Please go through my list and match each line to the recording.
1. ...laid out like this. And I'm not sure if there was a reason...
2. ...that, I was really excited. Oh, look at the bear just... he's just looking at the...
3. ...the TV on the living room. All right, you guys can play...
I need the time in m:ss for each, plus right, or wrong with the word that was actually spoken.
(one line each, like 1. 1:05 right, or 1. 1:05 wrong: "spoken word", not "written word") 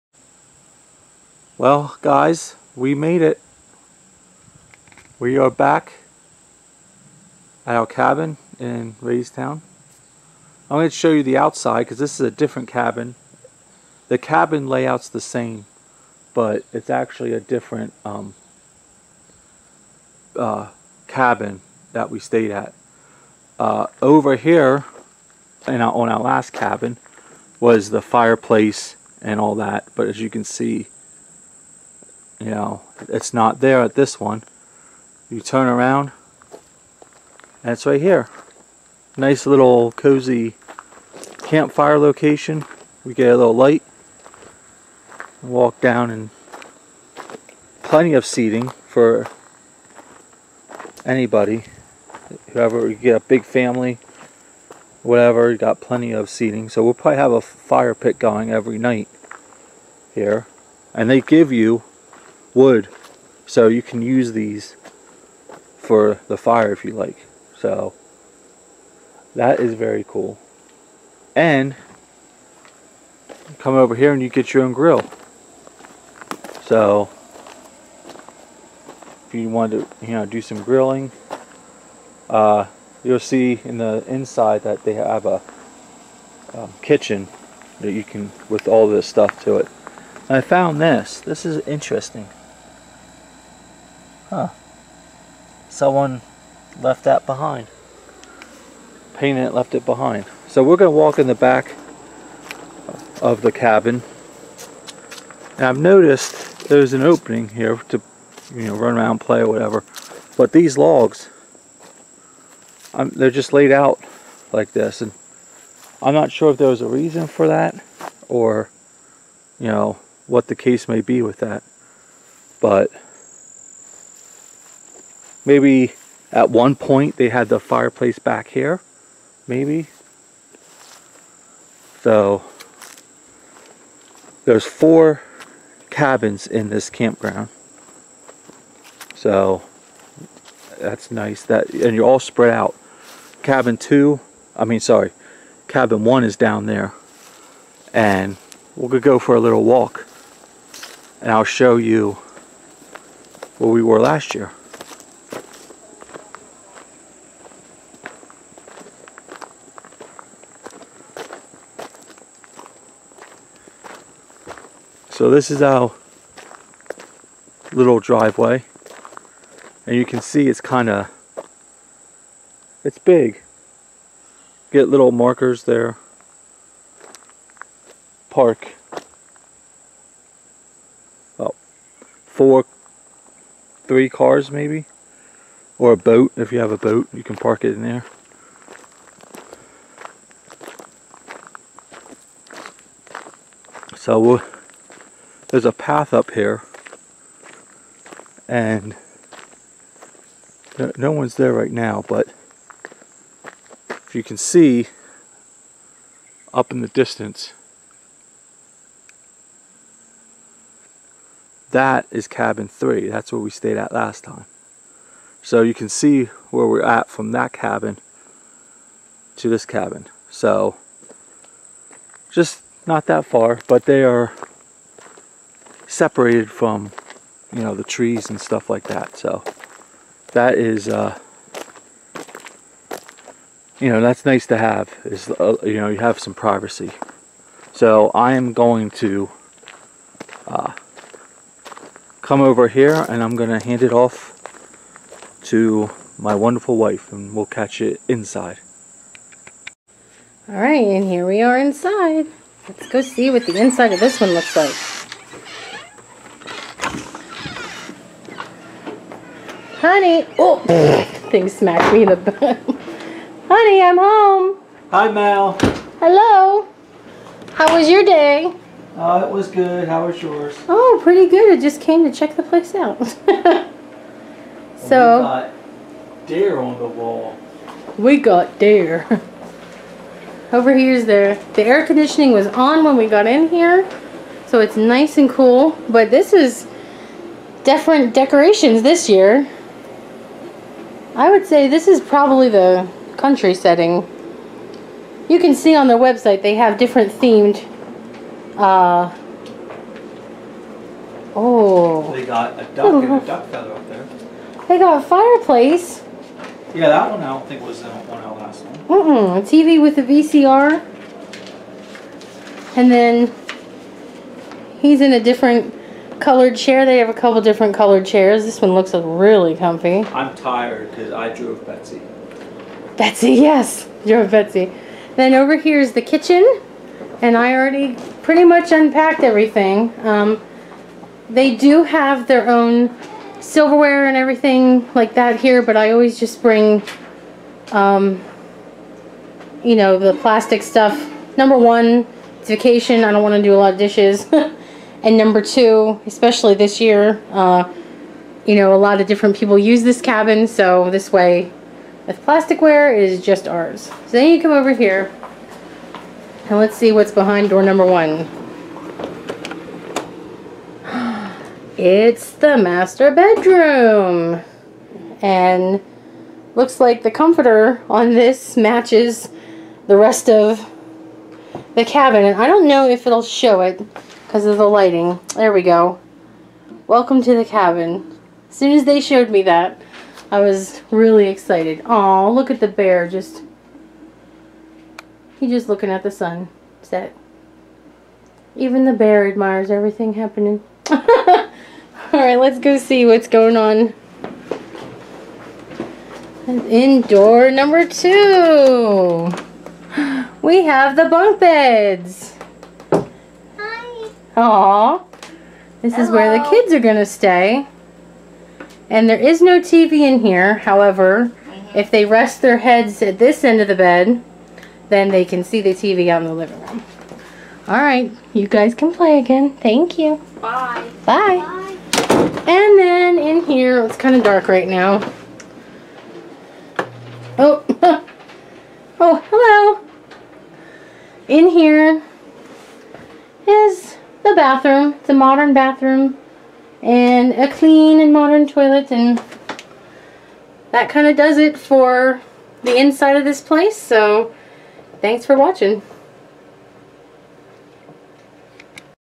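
1. 1:53 right
2. 6:19 right
3. 6:55 right.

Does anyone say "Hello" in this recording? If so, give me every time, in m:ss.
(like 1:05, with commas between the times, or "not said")
4:25, 6:45.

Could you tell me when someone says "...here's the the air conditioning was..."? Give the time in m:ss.
4:40.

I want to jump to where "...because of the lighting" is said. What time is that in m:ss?
6:14.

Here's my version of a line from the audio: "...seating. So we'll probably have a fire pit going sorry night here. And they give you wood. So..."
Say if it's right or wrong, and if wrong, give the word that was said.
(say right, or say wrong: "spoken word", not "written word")
wrong: "every", not "sorry".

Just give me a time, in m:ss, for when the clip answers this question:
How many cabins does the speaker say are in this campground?
2:14.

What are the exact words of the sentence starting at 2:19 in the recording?
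So that's nice that and you're all spread out.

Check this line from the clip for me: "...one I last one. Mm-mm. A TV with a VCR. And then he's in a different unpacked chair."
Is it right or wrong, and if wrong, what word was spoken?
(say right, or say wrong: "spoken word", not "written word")
wrong: "colored", not "unpacked".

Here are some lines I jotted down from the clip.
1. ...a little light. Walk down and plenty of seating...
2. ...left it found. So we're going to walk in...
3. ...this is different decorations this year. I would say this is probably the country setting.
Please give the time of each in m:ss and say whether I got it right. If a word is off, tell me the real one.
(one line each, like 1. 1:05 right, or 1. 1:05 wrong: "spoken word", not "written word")
1. 0:43 right
2. 1:39 wrong: "behind", not "found"
3. 4:46 right.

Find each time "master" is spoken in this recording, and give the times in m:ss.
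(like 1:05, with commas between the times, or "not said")
6:02.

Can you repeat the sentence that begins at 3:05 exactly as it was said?
Or a boat, if you have a boat, you can park it in there.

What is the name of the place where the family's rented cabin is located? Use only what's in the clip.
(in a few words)
Raystown.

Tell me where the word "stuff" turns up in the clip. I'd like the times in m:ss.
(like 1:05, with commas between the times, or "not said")
1:29, 3:48, 5:40.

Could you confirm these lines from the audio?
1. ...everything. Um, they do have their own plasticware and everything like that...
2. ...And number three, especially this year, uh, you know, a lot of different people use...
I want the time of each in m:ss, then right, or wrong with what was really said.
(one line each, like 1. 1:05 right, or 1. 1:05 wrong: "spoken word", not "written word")
1. 5:29 wrong: "silverware", not "plasticware"
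2. 5:45 wrong: "two", not "three".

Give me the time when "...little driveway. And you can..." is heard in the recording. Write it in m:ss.
2:47.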